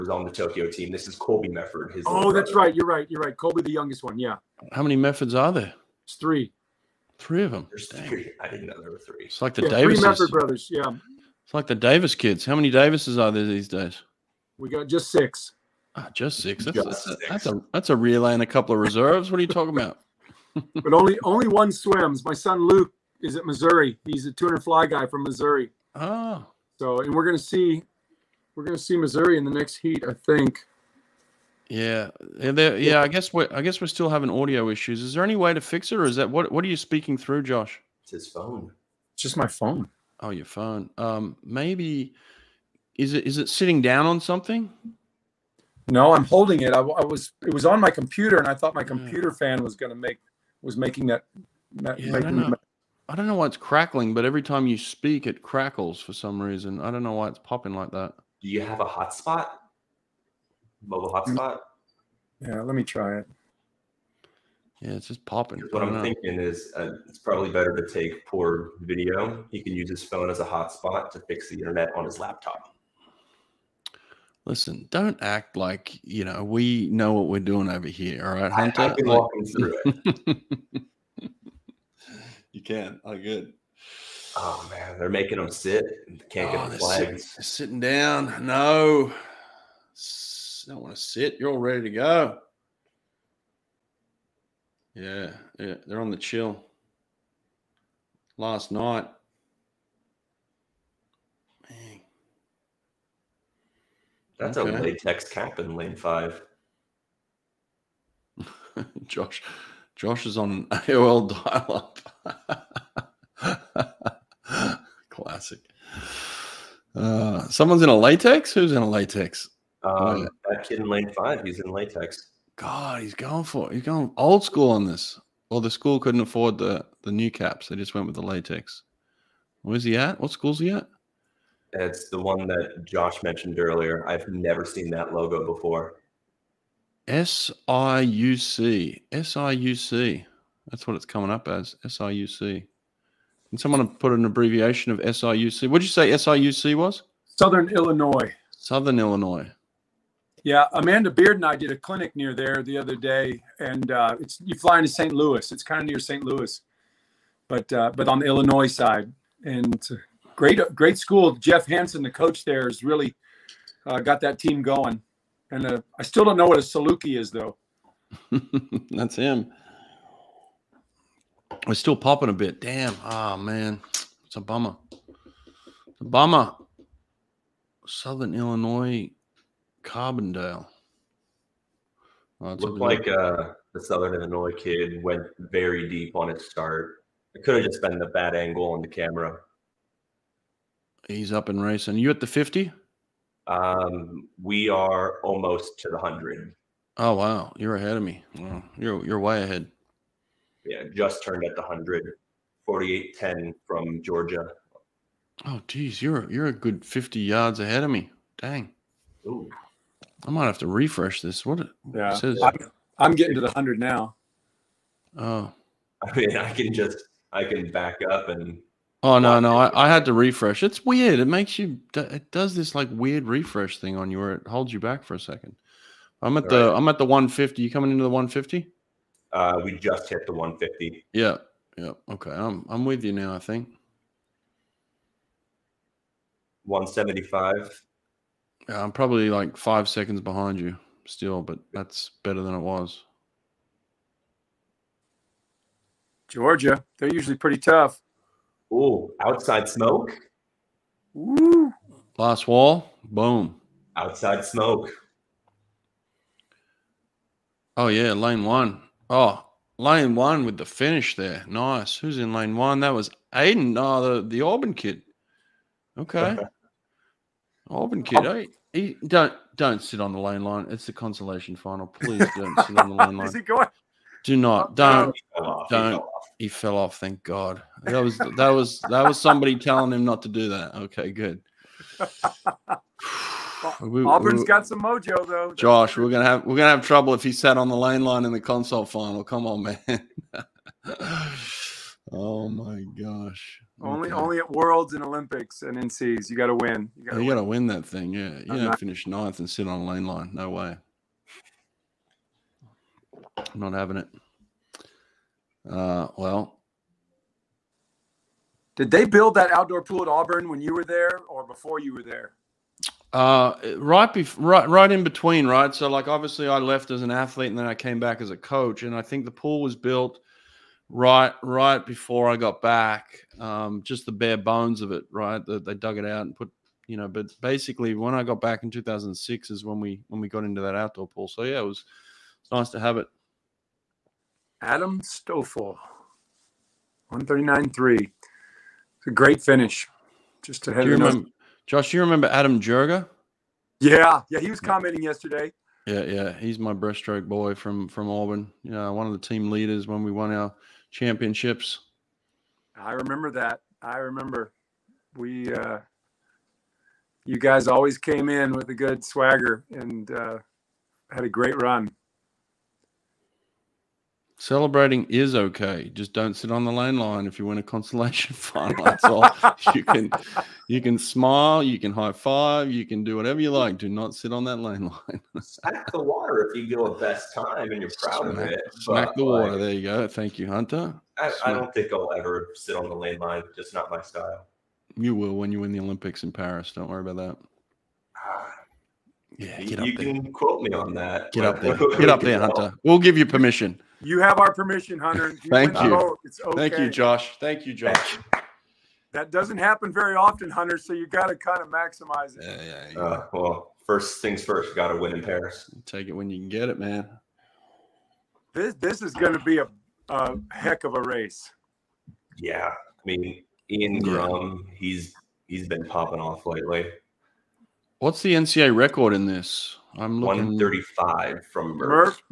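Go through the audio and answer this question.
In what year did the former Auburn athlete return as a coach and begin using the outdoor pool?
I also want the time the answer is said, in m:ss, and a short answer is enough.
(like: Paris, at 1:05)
2006, at 5:28.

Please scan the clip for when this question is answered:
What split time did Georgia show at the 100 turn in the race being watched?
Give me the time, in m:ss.
3:22.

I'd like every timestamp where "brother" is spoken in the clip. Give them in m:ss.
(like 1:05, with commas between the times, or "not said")
0:02, 0:10.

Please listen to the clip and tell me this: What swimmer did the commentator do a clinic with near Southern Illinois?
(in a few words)
Amanda Beard.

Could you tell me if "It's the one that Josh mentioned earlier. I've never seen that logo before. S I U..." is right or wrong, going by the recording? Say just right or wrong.
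right.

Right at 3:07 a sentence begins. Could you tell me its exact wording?
It could have just been the bad angle on the camera.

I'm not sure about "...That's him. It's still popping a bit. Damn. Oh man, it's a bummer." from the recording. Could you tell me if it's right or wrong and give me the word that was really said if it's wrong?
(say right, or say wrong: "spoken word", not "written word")
right.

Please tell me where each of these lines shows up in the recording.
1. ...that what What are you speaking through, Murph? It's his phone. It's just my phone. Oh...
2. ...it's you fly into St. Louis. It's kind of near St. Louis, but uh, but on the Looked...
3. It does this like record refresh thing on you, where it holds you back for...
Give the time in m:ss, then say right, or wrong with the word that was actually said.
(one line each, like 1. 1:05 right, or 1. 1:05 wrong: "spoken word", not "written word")
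1. 0:36 wrong: "Josh", not "Murph"
2. 2:34 wrong: "Illinois", not "Looked"
3. 3:41 wrong: "weird", not "record".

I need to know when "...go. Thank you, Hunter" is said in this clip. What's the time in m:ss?
6:19.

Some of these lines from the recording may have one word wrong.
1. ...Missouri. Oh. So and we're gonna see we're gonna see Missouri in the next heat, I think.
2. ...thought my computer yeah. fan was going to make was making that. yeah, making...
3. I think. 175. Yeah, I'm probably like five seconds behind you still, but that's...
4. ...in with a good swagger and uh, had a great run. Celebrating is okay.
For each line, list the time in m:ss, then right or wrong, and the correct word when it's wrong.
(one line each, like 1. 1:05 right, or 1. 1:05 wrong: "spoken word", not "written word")
1. 0:25 right
2. 0:48 right
3. 3:53 right
4. 5:58 right.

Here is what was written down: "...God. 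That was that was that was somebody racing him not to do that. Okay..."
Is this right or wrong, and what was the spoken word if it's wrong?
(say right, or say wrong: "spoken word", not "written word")
wrong: "telling", not "racing".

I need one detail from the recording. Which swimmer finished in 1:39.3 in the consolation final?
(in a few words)
Adam Stoffel.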